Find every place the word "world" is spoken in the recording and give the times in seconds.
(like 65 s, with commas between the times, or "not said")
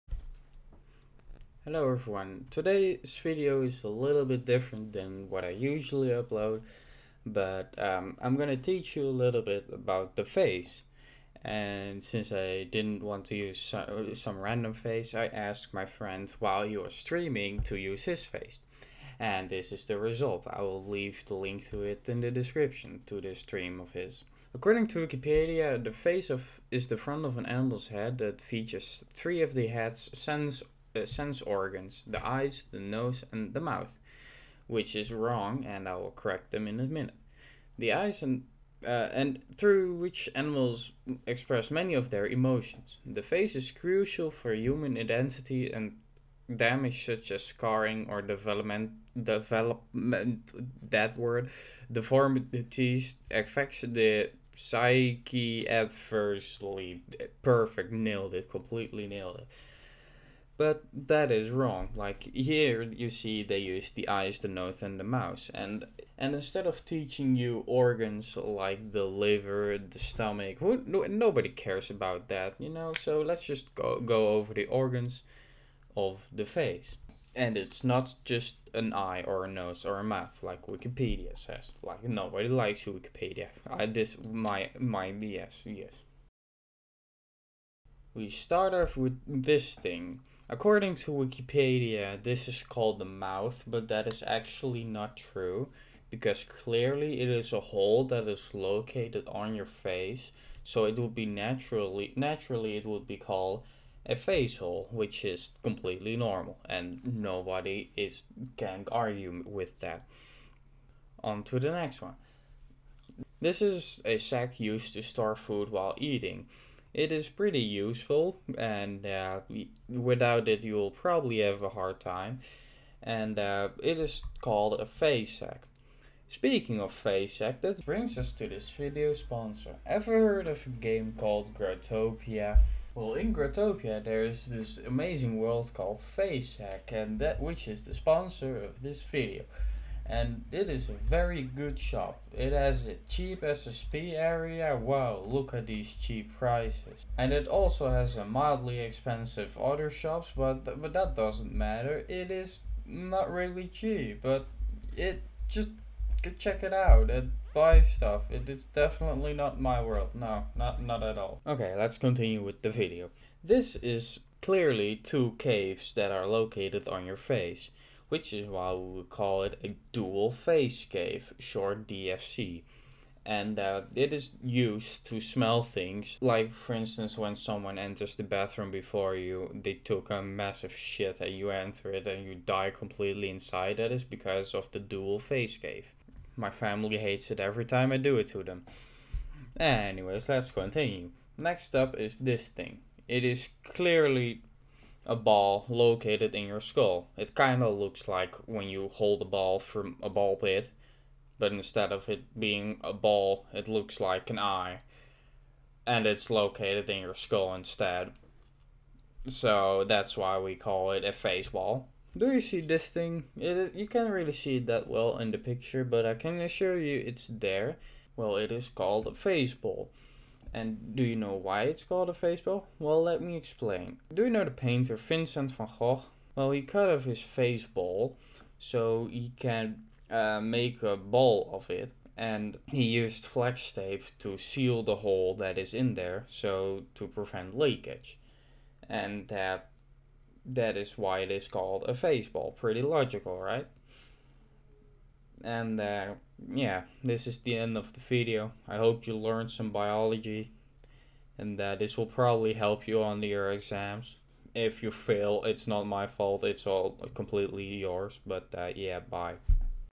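135 s, 159 s.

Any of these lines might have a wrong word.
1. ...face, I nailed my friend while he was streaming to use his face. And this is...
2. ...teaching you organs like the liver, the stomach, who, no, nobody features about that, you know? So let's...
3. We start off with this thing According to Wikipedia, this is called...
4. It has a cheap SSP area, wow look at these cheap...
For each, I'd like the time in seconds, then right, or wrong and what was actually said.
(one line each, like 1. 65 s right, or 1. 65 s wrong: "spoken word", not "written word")
1. 14 s wrong: "asked", not "nailed"
2. 66 s wrong: "cares", not "features"
3. 88 s right
4. 142 s right.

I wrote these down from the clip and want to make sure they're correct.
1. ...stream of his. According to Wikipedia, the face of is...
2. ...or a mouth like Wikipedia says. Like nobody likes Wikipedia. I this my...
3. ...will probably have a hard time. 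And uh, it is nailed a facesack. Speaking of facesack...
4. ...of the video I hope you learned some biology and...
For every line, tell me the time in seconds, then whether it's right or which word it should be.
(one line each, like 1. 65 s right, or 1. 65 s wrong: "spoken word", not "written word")
1. 23 s right
2. 79 s right
3. 120 s wrong: "called", not "nailed"
4. 247 s right.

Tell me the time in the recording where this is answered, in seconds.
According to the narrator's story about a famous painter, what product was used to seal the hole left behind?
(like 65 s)
233 s.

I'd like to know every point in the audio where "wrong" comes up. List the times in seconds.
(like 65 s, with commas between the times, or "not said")
35 s, 61 s.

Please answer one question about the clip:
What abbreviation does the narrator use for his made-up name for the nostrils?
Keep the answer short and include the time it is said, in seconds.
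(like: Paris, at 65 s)
DFC, at 171 s.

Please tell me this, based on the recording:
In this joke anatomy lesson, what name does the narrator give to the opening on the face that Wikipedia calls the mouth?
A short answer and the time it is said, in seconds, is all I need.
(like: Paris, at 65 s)
face hole, at 104 s.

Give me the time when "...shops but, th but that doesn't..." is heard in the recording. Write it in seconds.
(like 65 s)
149 s.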